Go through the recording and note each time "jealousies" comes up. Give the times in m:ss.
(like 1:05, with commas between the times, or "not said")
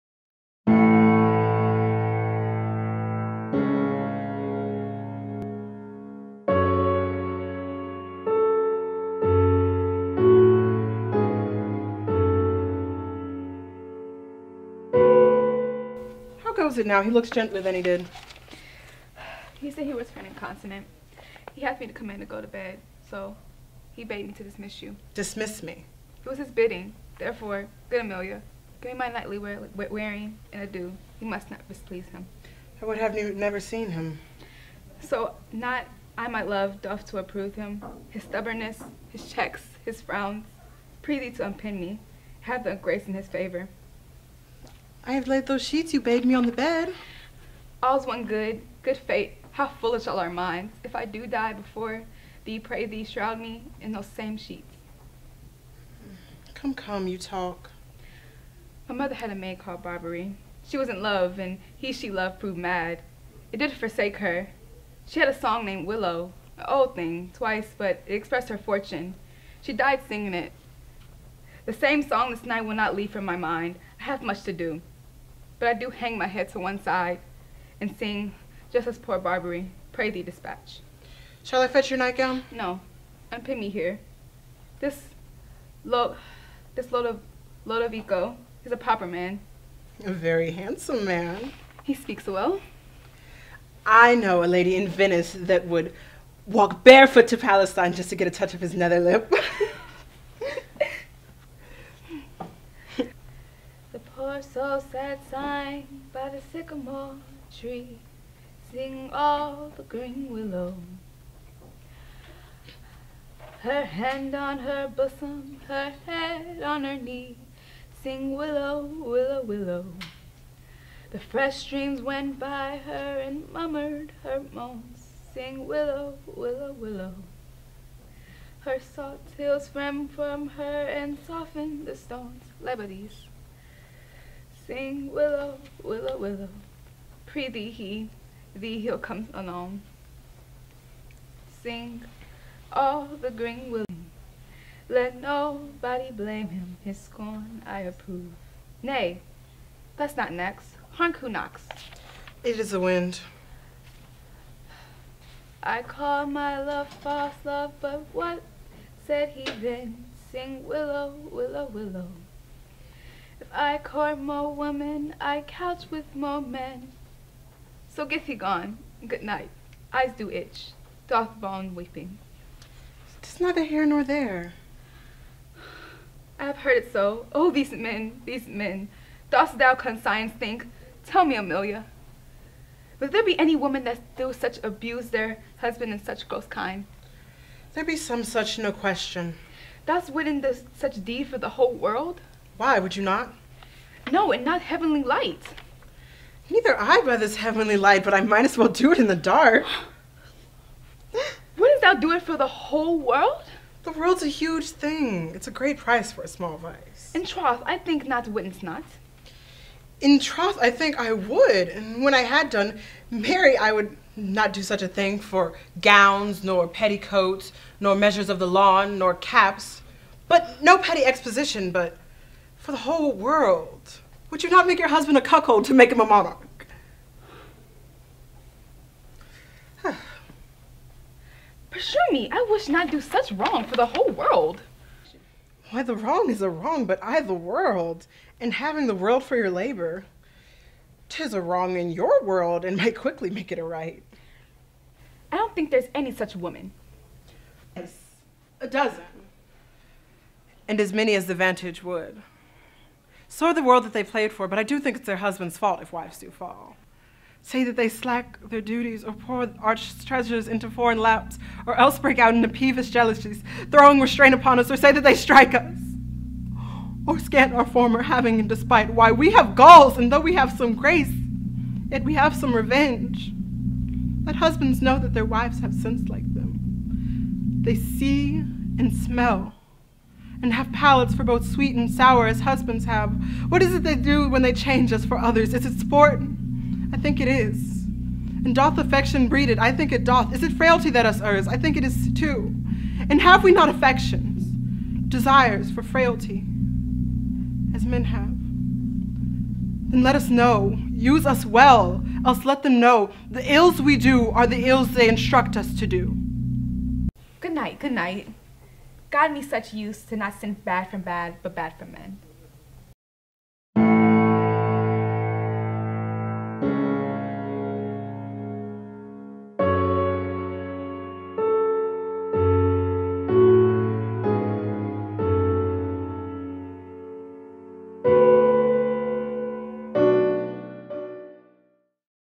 4:22.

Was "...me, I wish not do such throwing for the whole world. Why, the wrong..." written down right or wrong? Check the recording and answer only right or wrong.
wrong.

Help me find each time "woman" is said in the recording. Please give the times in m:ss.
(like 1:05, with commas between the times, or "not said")
3:03, 4:06.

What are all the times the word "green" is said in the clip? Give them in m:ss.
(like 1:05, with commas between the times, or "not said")
1:49, 2:23.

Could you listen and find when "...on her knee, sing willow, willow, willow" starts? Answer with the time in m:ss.
1:56.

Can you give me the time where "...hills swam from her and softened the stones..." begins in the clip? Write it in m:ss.
2:09.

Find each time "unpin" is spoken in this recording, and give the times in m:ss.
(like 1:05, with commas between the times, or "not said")
0:41, 1:23.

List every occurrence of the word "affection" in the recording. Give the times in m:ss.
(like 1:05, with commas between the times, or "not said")
4:48, 4:53.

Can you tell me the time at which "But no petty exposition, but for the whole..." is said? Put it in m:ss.
3:40.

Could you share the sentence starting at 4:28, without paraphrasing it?
Why, we have galls, and though we have some grace, yet we have some revenge.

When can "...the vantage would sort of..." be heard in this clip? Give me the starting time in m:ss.
4:11.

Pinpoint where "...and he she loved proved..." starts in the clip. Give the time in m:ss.
1:01.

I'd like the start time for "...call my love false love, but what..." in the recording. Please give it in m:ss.
2:35.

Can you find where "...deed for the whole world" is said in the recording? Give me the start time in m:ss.
3:11.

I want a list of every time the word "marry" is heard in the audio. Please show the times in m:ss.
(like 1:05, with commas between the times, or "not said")
3:33.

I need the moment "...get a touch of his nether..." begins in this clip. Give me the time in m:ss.
1:38.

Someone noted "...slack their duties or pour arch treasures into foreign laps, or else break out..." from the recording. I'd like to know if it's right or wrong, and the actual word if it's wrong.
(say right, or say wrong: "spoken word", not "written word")
right.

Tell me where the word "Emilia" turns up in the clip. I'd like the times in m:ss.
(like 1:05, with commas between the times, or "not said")
0:28, 3:01.